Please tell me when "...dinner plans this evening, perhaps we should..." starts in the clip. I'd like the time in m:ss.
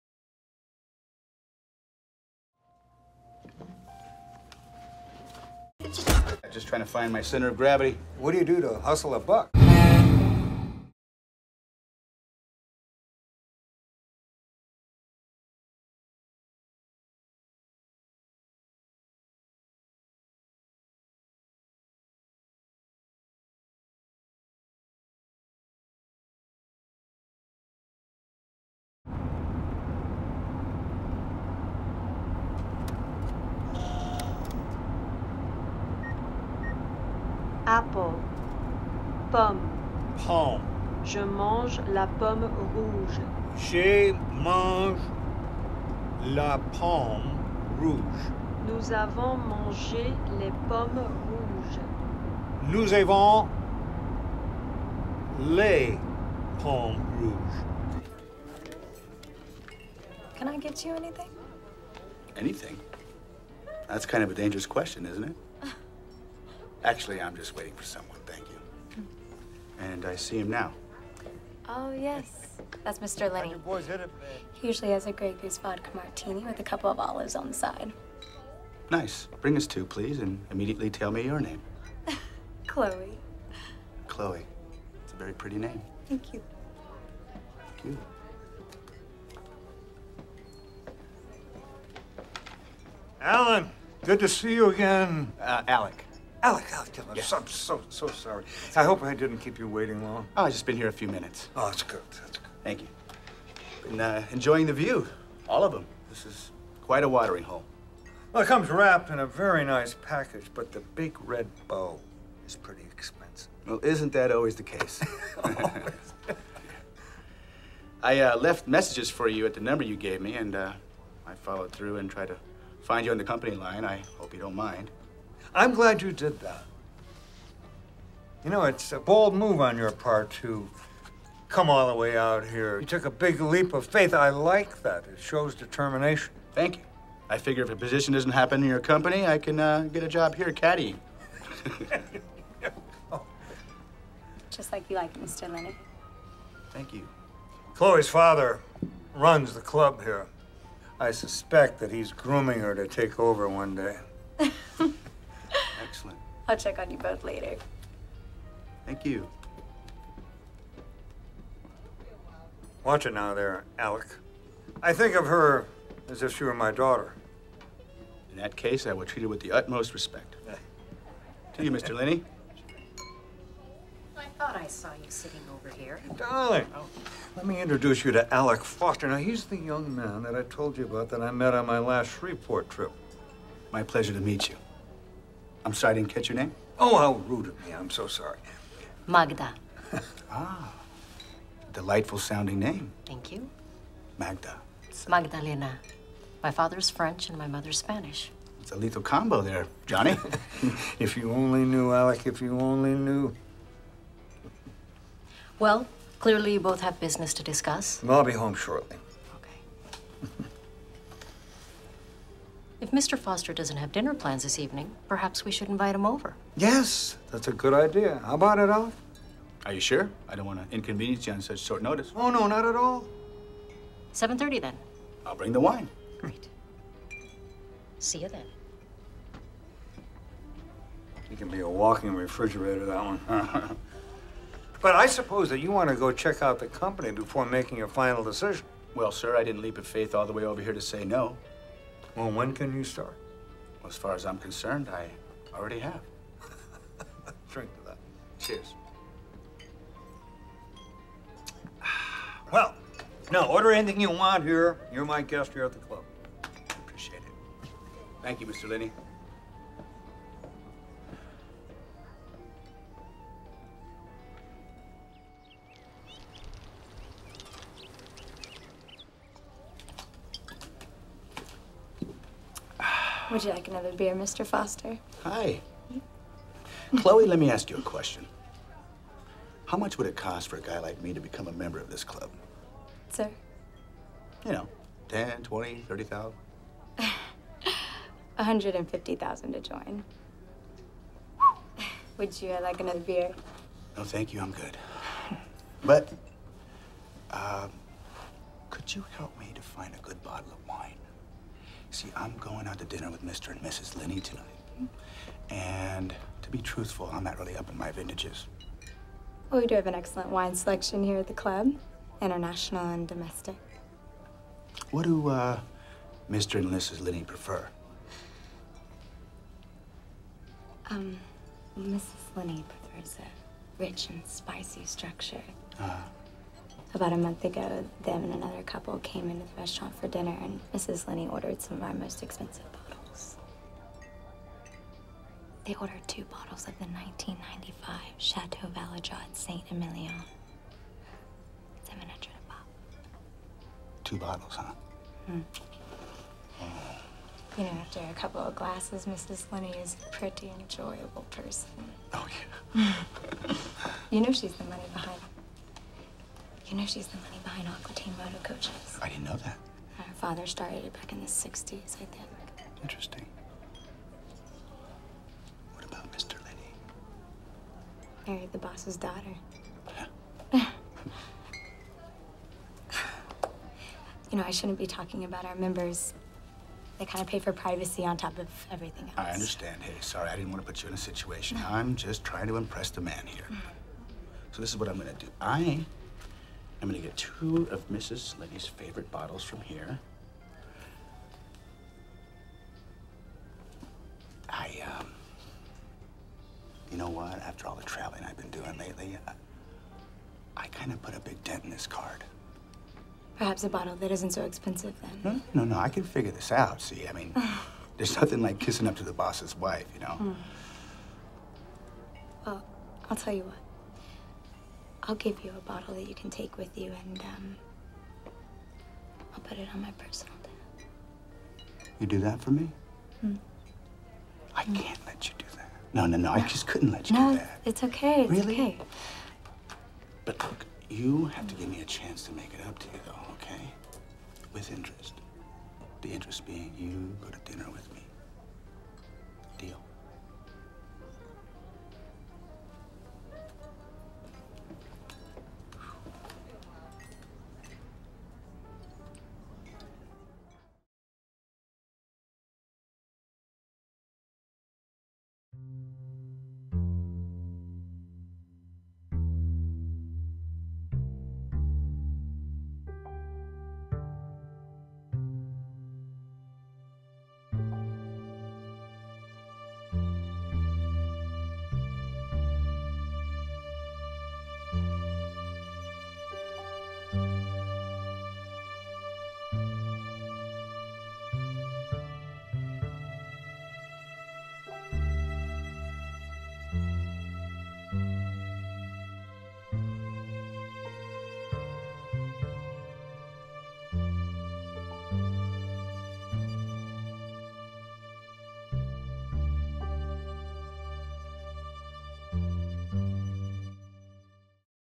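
3:33.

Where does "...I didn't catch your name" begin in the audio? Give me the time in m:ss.
3:05.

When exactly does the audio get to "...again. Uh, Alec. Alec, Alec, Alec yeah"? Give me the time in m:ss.
1:34.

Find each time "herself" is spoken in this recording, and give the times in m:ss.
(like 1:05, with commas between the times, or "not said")
not said.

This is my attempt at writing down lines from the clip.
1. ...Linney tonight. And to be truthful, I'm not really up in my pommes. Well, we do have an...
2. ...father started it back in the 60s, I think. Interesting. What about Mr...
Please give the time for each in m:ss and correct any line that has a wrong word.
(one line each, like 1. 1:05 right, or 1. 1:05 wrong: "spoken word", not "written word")
1. 5:03 wrong: "vintages", not "pommes"
2. 6:00 right.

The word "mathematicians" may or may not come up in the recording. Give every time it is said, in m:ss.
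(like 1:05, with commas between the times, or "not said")
not said.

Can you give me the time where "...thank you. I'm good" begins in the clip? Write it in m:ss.
4:54.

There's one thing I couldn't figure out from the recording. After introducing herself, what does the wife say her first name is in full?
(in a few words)
Magdalena.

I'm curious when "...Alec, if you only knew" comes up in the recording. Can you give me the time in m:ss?
3:21.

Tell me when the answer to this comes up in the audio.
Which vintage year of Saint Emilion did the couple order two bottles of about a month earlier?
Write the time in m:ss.
5:36.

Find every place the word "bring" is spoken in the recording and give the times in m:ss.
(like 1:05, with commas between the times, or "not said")
1:19, 3:45.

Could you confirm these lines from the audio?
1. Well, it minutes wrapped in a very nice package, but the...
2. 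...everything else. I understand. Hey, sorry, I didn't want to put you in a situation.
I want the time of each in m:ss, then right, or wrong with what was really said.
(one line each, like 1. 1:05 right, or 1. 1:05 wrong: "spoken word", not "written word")
1. 1:48 wrong: "comes", not "minutes"
2. 6:18 right.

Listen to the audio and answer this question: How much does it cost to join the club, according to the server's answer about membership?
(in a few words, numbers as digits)
150,000.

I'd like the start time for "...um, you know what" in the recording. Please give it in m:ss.
6:34.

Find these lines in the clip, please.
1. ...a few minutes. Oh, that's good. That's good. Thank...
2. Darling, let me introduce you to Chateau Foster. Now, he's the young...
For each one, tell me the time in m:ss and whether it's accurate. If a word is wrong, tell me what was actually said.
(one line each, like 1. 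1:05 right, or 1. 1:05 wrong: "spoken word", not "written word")
1. 1:40 right
2. 2:56 wrong: "Alec", not "Chateau".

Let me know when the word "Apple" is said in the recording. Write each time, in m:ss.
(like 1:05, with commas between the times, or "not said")
0:37.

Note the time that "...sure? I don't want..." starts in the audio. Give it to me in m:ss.
3:39.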